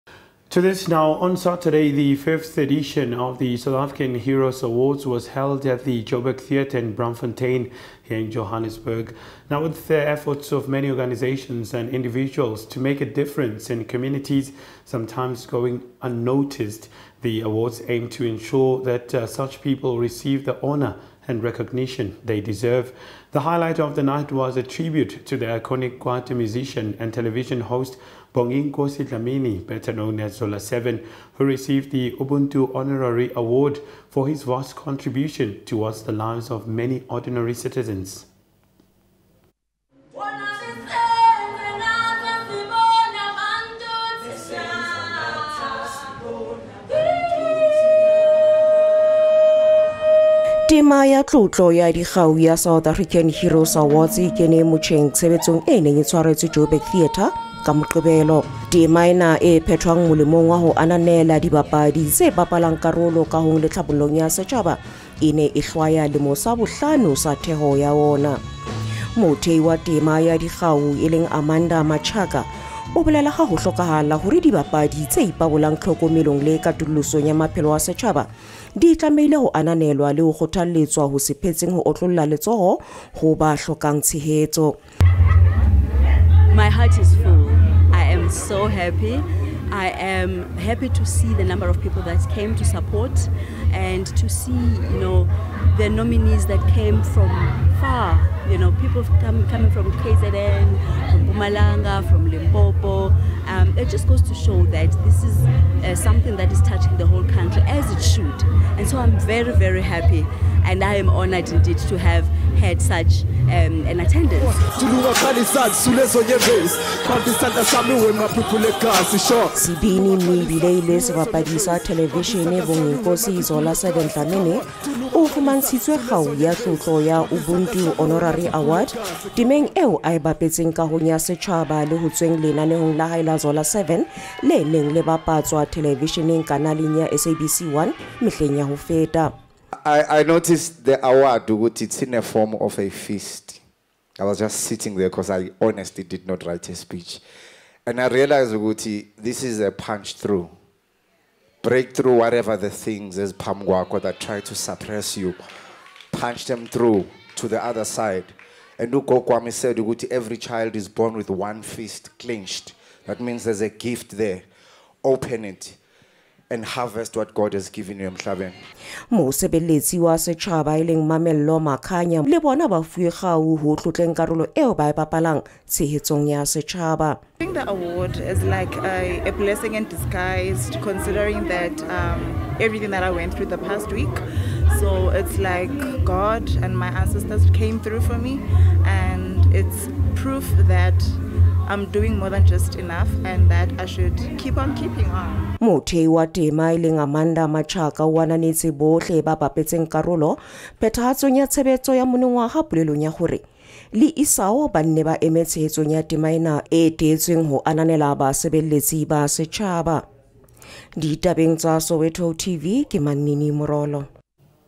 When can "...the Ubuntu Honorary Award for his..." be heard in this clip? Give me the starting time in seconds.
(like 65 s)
31 s.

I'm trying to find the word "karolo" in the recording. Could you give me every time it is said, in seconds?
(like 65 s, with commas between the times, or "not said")
62 s, 174 s, 199 s.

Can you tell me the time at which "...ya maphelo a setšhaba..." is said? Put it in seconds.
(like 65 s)
77 s.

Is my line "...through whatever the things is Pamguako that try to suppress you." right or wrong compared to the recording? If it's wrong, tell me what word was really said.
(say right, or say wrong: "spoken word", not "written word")
right.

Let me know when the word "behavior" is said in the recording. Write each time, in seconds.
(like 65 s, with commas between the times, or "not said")
not said.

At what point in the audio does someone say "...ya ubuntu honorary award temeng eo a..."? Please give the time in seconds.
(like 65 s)
127 s.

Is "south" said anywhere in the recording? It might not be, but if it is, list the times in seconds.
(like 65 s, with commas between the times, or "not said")
3 s, 52 s.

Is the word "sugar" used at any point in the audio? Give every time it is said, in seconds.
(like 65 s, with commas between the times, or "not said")
not said.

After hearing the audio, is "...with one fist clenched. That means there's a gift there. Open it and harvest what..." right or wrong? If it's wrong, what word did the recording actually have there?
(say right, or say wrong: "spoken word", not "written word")
right.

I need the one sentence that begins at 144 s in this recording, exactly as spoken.
I was just sitting there because I honestly did not write a speech.